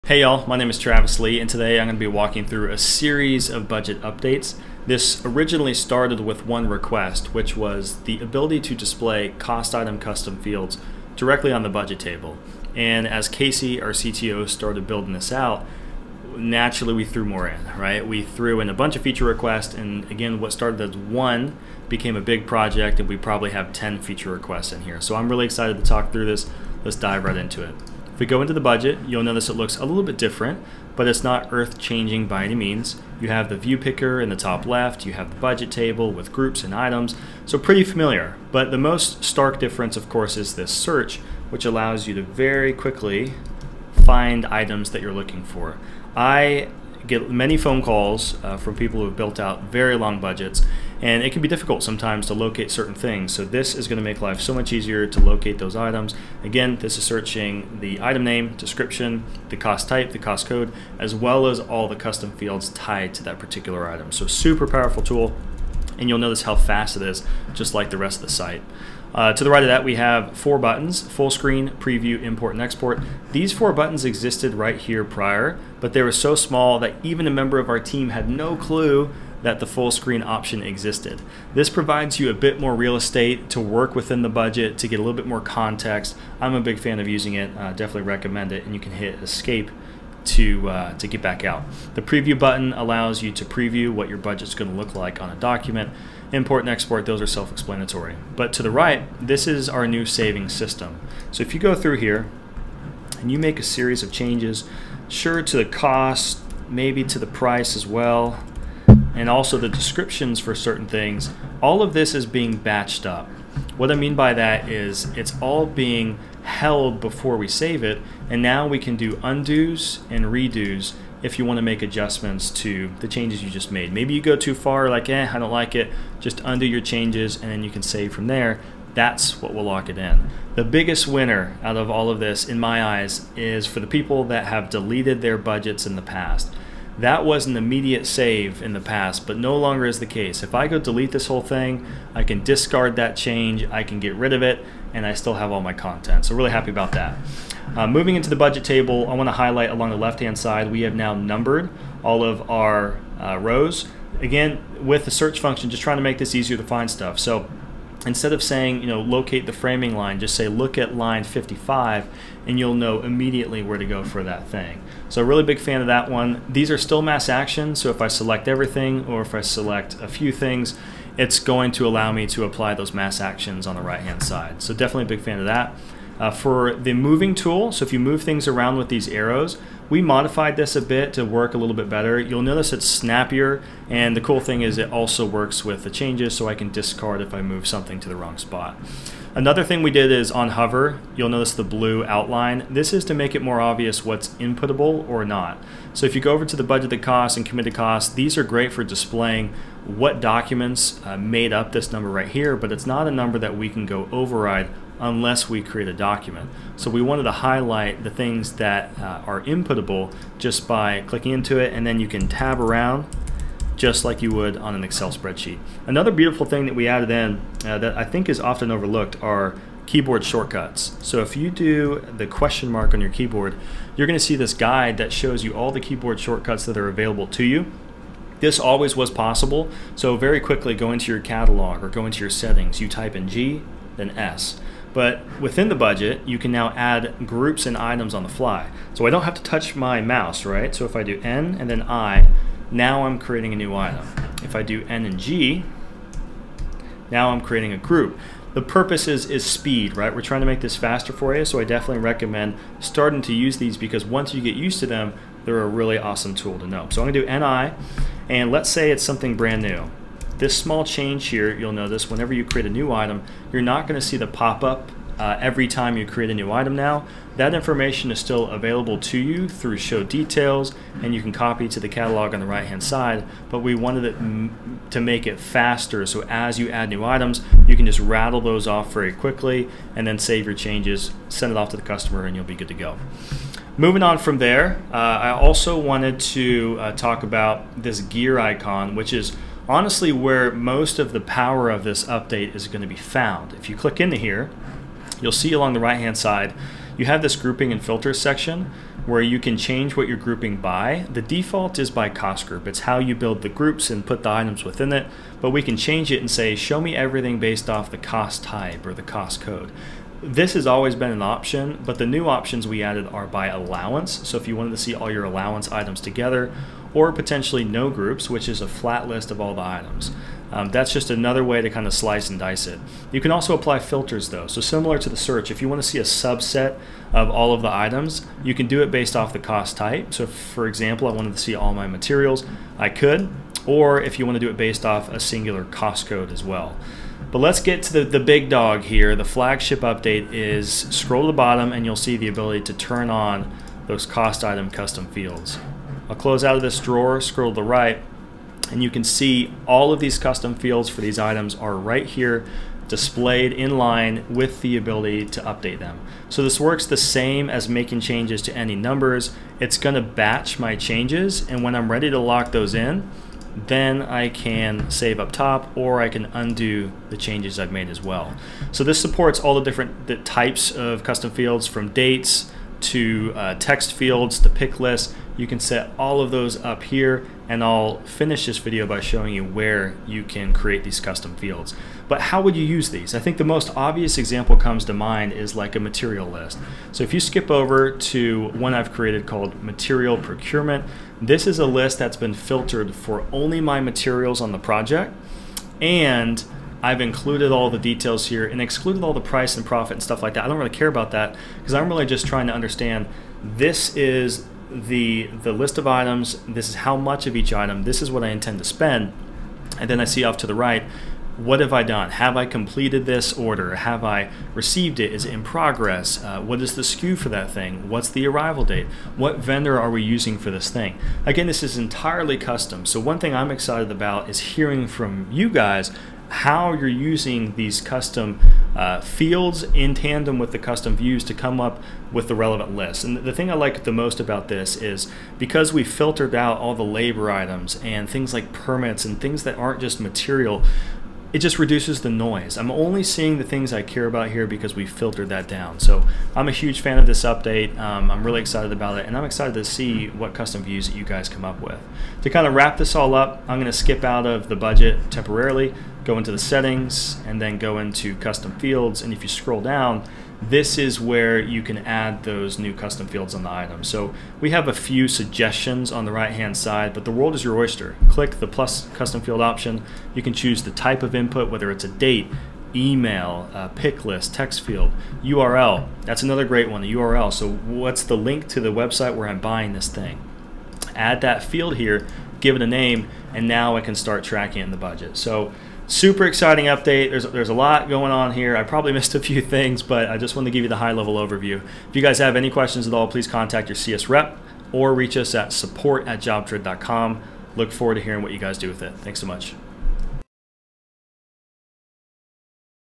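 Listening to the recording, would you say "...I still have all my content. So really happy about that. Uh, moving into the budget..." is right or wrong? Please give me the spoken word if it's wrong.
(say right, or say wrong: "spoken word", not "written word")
right.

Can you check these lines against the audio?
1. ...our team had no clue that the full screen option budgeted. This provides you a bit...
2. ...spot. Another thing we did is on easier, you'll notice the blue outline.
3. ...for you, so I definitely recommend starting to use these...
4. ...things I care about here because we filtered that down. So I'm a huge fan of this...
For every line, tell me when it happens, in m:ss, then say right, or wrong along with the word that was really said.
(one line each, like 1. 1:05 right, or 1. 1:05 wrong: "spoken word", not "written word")
1. 1:17 wrong: "existed", not "budgeted"
2. 3:08 wrong: "hover", not "easier"
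3. 4:11 right
4. 7:23 right.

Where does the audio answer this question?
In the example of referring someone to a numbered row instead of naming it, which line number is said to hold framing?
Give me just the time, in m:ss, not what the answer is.
2:41.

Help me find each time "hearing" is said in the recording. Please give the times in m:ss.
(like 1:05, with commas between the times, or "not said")
7:04, 8:18.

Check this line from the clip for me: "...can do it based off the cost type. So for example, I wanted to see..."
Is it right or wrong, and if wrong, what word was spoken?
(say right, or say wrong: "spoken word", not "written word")
right.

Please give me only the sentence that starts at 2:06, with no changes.
Just undo your changes and then you can save from there.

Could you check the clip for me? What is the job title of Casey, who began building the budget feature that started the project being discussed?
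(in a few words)
CTO.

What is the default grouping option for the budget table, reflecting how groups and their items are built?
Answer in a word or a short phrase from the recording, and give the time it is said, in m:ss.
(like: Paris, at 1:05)
Cost group, at 5:02.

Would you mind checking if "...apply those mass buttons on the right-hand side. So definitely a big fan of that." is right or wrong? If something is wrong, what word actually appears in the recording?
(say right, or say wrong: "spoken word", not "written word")
wrong: "actions", not "buttons".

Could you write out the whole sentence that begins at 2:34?
Again, with the search function, just trying to make this easier to find stuff.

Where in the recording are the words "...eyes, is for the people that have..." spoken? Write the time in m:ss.
2:12.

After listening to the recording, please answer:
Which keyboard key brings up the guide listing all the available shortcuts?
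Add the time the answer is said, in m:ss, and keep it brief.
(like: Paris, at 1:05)
Question mark, at 3:42.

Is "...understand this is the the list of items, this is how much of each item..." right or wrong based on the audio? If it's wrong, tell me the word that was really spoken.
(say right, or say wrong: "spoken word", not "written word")
right.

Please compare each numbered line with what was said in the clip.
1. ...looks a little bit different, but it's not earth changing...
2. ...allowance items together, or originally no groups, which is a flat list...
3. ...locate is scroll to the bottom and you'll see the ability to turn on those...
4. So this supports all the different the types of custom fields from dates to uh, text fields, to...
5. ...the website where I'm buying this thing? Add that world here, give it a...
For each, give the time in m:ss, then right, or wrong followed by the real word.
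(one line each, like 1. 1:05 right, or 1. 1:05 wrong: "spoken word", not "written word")
1. 0:29 right
2. 5:15 wrong: "potentially", not "originally"
3. 5:39 wrong: "update", not "locate"
4. 6:08 right
5. 7:58 wrong: "field", not "world".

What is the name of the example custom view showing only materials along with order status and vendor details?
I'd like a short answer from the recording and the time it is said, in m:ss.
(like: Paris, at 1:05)
Material procurement, at 6:29.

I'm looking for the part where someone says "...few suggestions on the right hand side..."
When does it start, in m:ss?
7:44.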